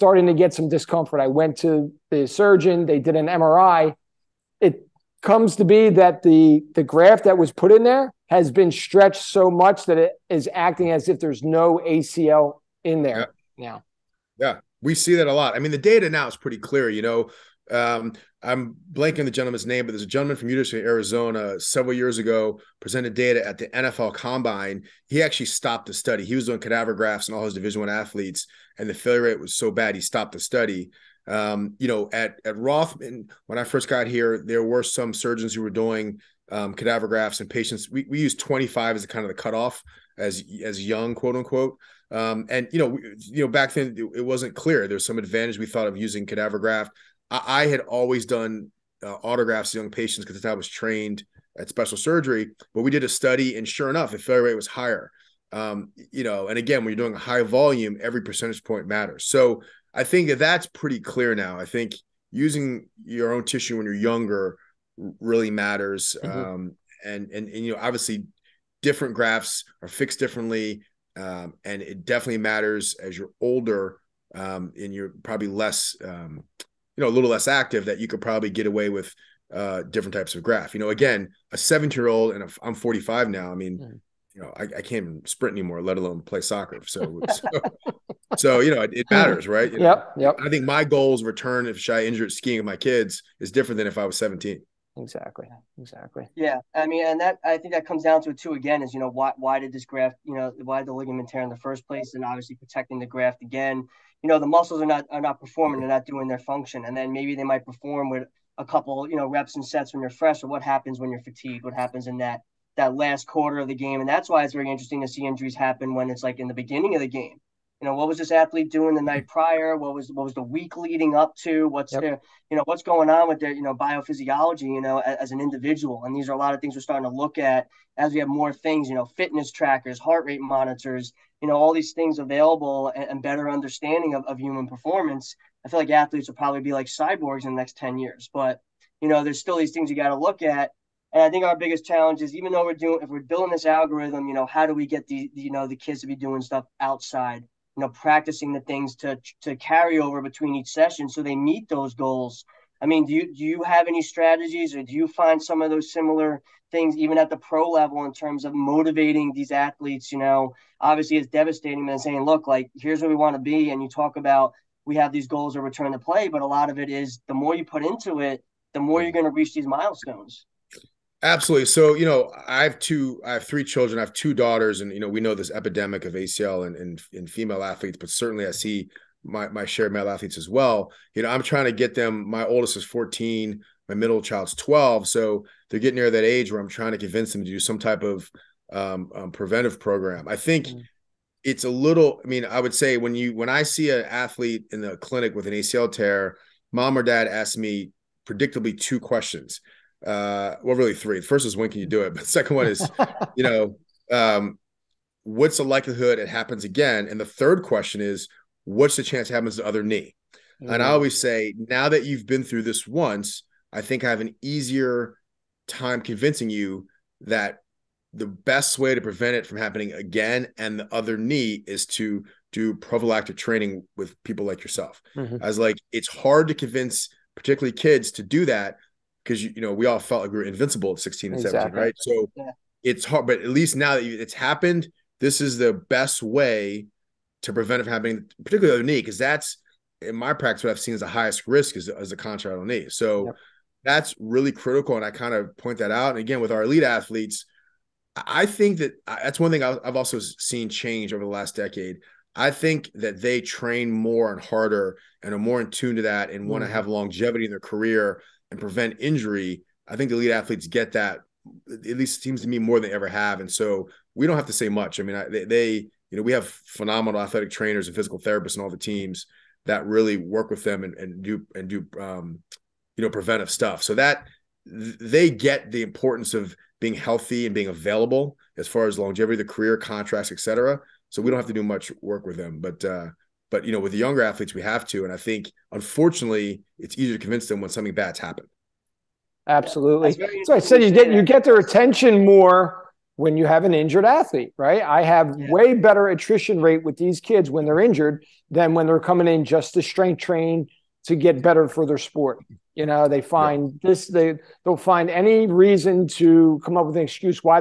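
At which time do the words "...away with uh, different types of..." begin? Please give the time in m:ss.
1:18.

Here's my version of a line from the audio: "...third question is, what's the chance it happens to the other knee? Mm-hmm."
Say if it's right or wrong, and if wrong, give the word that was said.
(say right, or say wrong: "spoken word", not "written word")
right.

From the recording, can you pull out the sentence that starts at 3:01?
You know, I'm trying to get them.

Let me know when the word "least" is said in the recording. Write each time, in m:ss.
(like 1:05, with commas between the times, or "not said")
3:53, 4:21.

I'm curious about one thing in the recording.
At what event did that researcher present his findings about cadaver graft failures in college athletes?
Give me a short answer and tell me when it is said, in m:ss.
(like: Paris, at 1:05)
NFL Combine, at 0:23.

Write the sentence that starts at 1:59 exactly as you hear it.
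night prior what was what was the week leading up to what's yep.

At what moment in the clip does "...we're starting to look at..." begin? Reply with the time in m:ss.
2:06.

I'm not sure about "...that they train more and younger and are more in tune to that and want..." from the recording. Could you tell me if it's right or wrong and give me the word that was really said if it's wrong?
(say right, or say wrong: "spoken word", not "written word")
wrong: "harder", not "younger".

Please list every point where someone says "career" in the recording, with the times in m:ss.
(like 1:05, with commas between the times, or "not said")
4:17, 4:39.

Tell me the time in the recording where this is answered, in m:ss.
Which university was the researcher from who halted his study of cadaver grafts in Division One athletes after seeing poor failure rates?
0:20.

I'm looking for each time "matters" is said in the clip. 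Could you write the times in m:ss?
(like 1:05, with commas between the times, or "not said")
0:58, 1:05, 1:12, 1:29.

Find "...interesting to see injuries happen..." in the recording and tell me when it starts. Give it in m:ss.
1:54.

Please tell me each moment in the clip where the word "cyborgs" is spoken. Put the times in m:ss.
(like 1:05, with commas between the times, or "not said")
2:16.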